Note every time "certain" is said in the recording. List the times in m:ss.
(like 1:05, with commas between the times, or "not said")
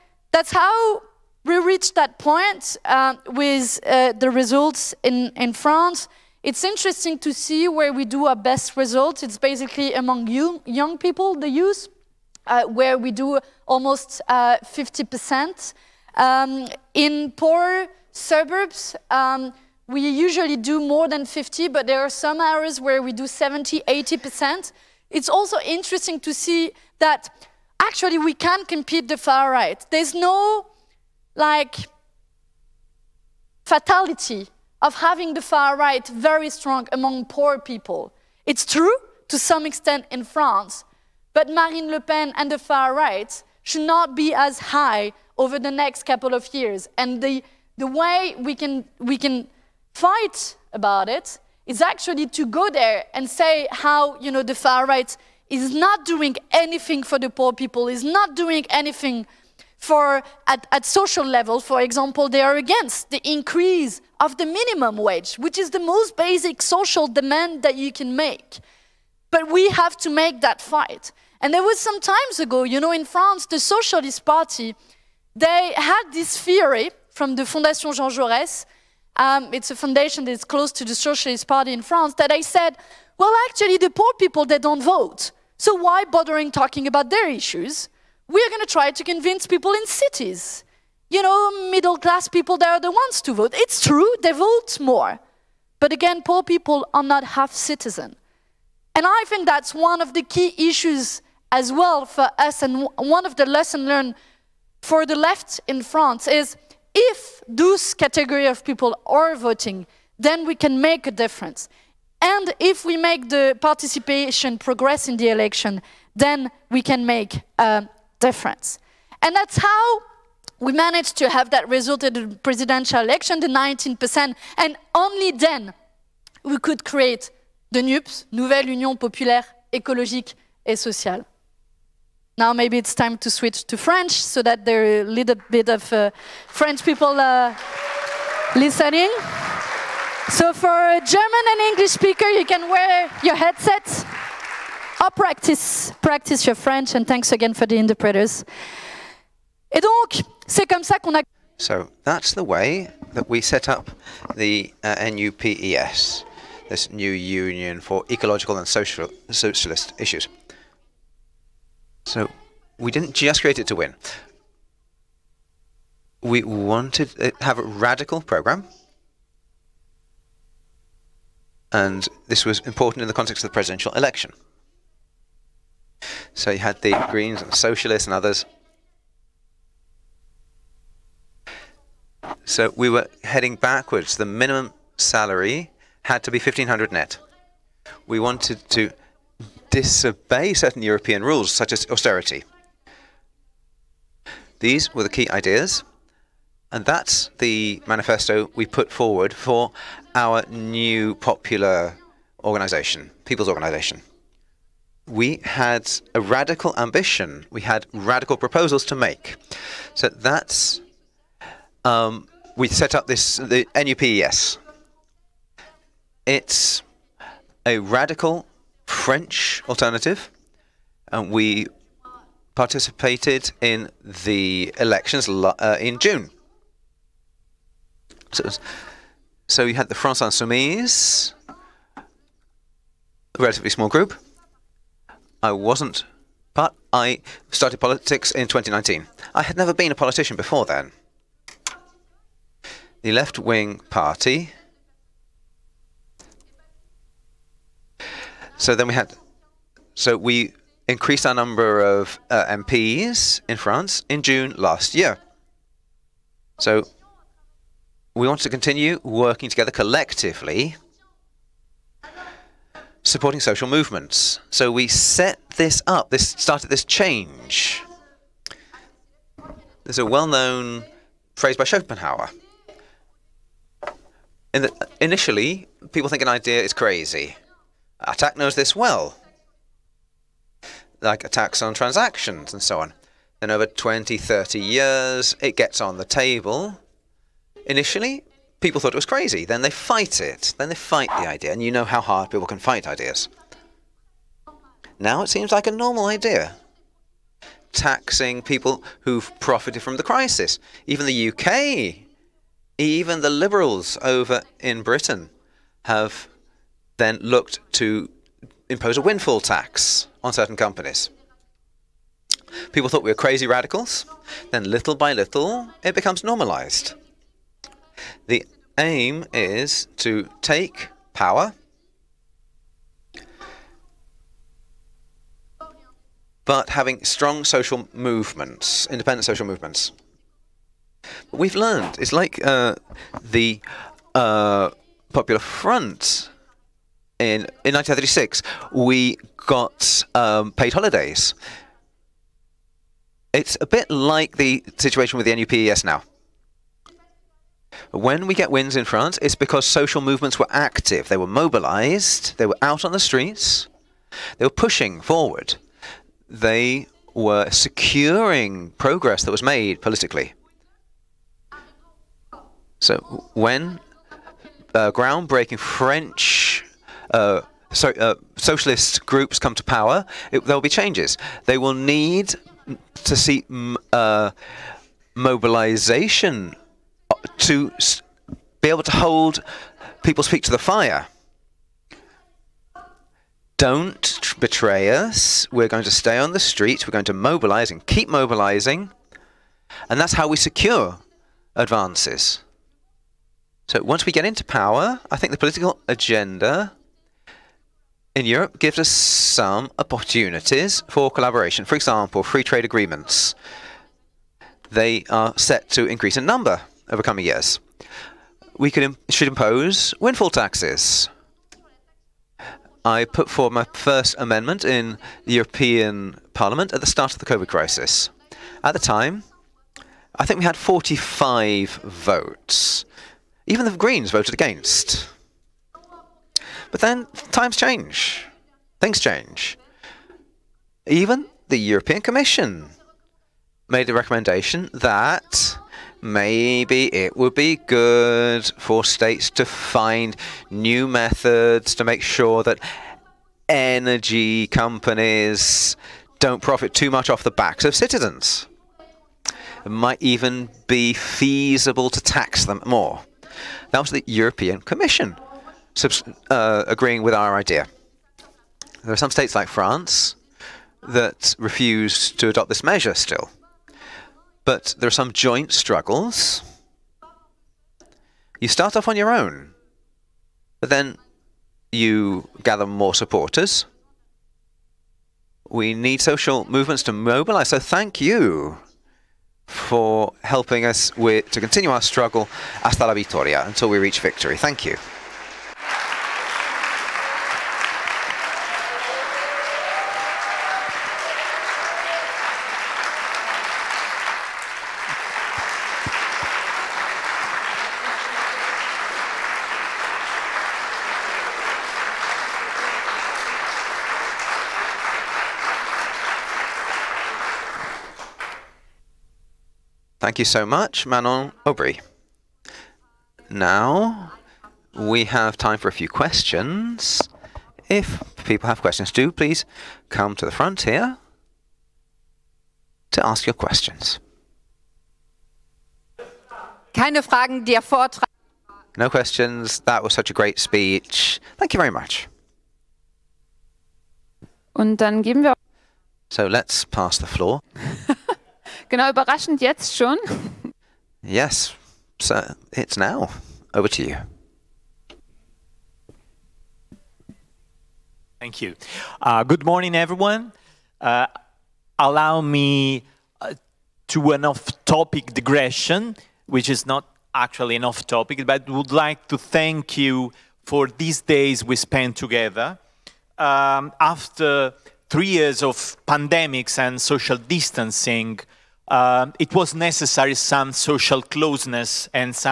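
3:10, 5:10.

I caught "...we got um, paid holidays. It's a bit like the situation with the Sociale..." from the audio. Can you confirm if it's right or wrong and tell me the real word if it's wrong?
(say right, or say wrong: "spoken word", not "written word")
wrong: "NUPES", not "Sociale".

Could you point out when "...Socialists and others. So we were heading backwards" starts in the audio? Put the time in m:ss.
2:57.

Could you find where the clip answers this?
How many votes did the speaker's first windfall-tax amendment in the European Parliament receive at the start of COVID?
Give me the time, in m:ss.
7:00.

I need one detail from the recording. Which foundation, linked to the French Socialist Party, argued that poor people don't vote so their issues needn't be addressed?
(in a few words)
Fondation Jean Jaurès.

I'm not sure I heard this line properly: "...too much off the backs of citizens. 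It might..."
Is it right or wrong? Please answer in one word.
right.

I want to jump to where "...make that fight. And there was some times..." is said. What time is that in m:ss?
1:10.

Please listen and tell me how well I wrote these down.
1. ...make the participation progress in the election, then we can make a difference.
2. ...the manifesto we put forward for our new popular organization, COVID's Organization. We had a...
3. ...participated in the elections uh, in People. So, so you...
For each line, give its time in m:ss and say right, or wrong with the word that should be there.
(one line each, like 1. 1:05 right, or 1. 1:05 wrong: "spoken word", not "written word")
1. 1:52 right
2. 3:17 wrong: "People", not "COVID"
3. 3:42 wrong: "June", not "People".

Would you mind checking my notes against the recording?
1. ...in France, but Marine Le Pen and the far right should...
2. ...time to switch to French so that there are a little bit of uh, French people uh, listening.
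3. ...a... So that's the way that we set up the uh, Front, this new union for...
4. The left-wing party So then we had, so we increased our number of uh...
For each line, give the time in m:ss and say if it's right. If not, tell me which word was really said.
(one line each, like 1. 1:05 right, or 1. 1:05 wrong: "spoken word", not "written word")
1. 0:40 right
2. 2:12 right
3. 2:31 wrong: "NUPES", not "Front"
4. 4:03 right.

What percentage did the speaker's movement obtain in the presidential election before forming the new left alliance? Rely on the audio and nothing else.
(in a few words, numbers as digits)
19%.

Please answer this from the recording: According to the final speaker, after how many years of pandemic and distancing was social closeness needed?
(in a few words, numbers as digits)
3.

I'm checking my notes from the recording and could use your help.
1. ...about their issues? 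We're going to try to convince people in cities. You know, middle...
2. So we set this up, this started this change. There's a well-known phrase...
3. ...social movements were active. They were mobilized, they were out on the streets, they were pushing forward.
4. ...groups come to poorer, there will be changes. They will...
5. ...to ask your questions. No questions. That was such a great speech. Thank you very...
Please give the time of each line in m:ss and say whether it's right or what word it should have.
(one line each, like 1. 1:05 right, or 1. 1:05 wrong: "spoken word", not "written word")
1. 1:26 right
2. 4:24 right
3. 5:49 right
4. 6:09 wrong: "power", not "poorer"
5. 8:42 right.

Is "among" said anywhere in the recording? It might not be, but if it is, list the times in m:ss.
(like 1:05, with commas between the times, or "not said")
0:09, 0:36.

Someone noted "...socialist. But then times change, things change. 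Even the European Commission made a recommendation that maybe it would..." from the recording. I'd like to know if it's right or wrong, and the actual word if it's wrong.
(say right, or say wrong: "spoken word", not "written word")
wrong: "against", not "socialist".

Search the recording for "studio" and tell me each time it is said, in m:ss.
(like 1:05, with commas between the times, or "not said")
not said.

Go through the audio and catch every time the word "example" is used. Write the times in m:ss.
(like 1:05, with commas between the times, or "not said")
1:01, 6:41.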